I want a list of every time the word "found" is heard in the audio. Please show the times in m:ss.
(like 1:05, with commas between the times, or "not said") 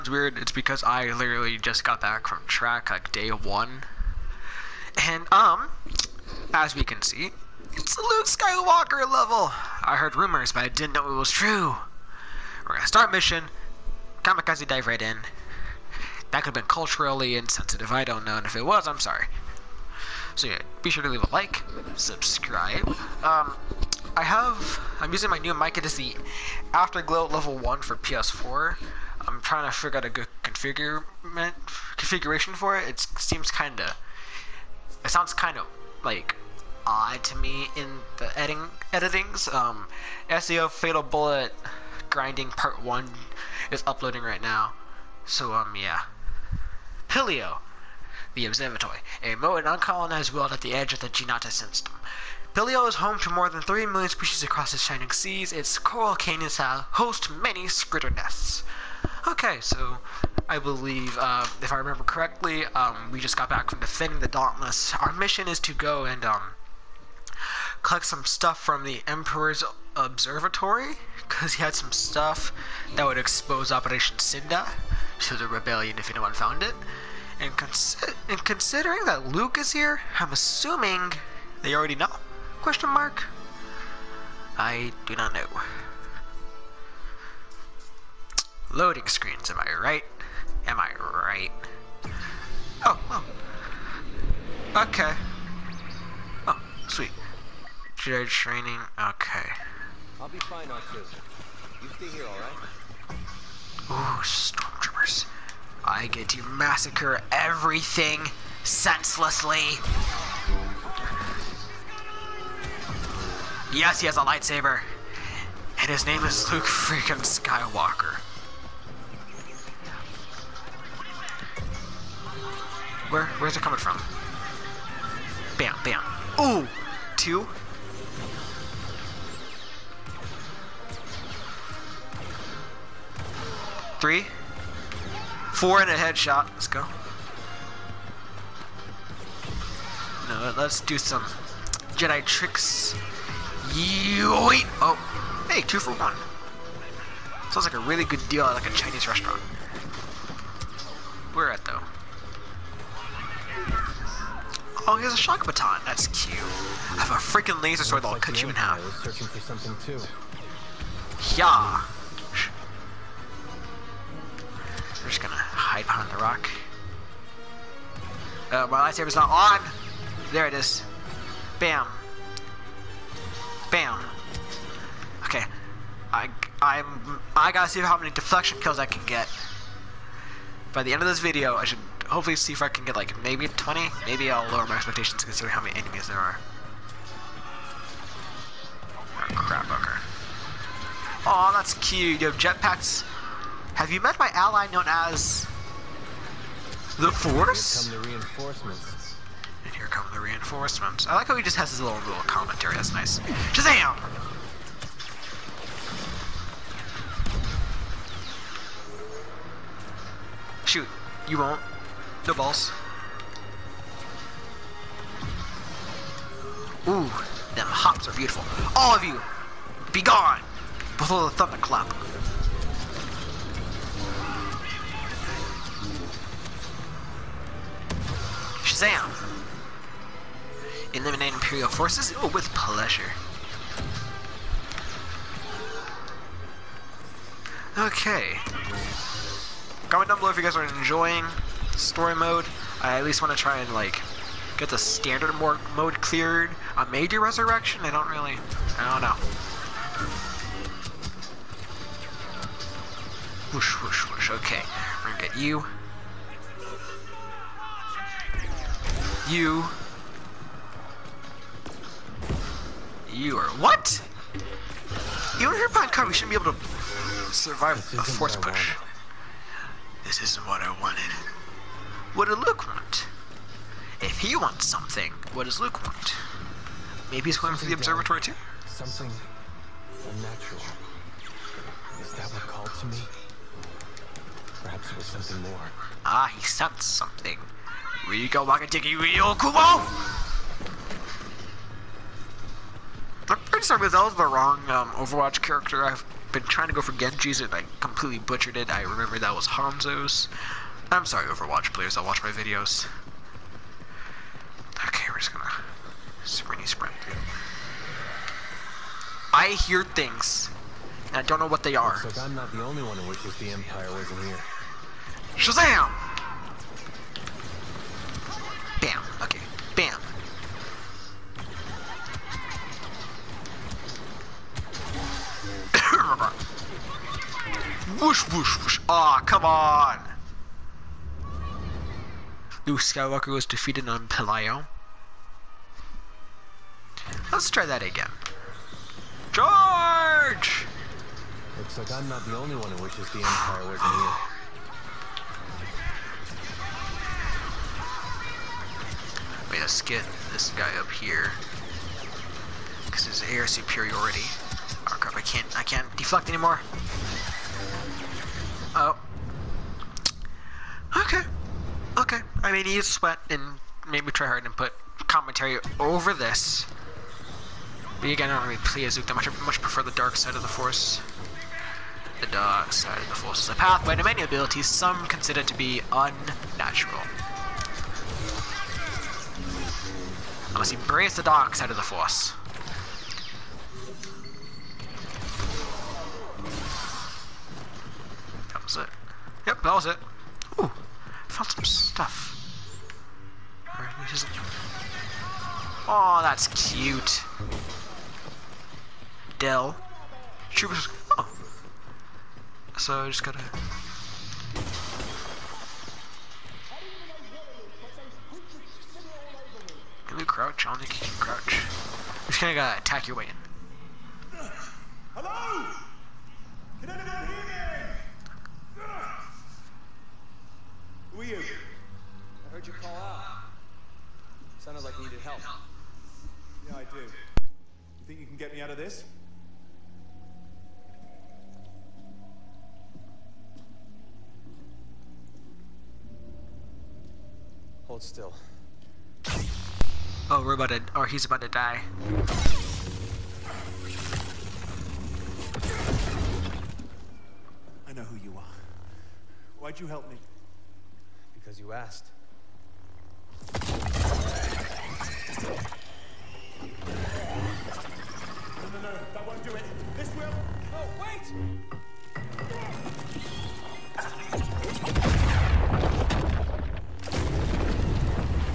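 1:16, 6:31.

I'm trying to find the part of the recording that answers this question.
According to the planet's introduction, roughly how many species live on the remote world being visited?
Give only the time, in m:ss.
0:53.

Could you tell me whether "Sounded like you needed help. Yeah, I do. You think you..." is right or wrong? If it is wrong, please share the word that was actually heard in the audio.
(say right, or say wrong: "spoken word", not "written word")
right.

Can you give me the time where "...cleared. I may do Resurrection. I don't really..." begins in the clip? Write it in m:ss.
4:06.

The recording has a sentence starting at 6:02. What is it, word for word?
mean, you sweat and maybe try hard and put commentary over this.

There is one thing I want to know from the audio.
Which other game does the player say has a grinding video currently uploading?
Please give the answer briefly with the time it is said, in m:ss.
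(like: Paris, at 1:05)
SAO Fatal Bullet, at 0:40.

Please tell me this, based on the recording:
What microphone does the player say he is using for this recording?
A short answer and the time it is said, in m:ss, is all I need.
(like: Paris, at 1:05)
Afterglow Level 1, at 0:26.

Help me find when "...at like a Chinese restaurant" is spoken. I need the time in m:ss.
2:28.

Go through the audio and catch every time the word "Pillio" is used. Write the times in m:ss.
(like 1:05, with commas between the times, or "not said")
0:47, 0:52.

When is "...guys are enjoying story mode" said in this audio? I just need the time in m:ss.
4:00.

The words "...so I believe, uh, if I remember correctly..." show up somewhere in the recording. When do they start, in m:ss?
0:59.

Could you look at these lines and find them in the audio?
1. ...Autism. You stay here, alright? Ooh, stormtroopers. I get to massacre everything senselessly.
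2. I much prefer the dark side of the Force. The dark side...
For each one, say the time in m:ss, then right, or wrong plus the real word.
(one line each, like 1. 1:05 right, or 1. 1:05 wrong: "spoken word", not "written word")
1. 1:40 right
2. 6:09 right.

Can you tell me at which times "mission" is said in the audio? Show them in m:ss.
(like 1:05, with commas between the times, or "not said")
0:13, 1:05.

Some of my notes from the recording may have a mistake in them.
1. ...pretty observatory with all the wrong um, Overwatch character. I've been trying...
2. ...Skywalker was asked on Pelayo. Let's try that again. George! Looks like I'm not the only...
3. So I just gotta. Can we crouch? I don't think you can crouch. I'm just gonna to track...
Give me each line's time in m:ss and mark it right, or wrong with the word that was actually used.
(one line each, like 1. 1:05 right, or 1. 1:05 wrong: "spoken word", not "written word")
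1. 4:53 wrong: "sorry", not "observatory"
2. 5:32 wrong: "defeated", not "asked"
3. 6:42 wrong: "attack", not "track".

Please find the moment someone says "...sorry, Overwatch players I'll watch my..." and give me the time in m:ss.
5:01.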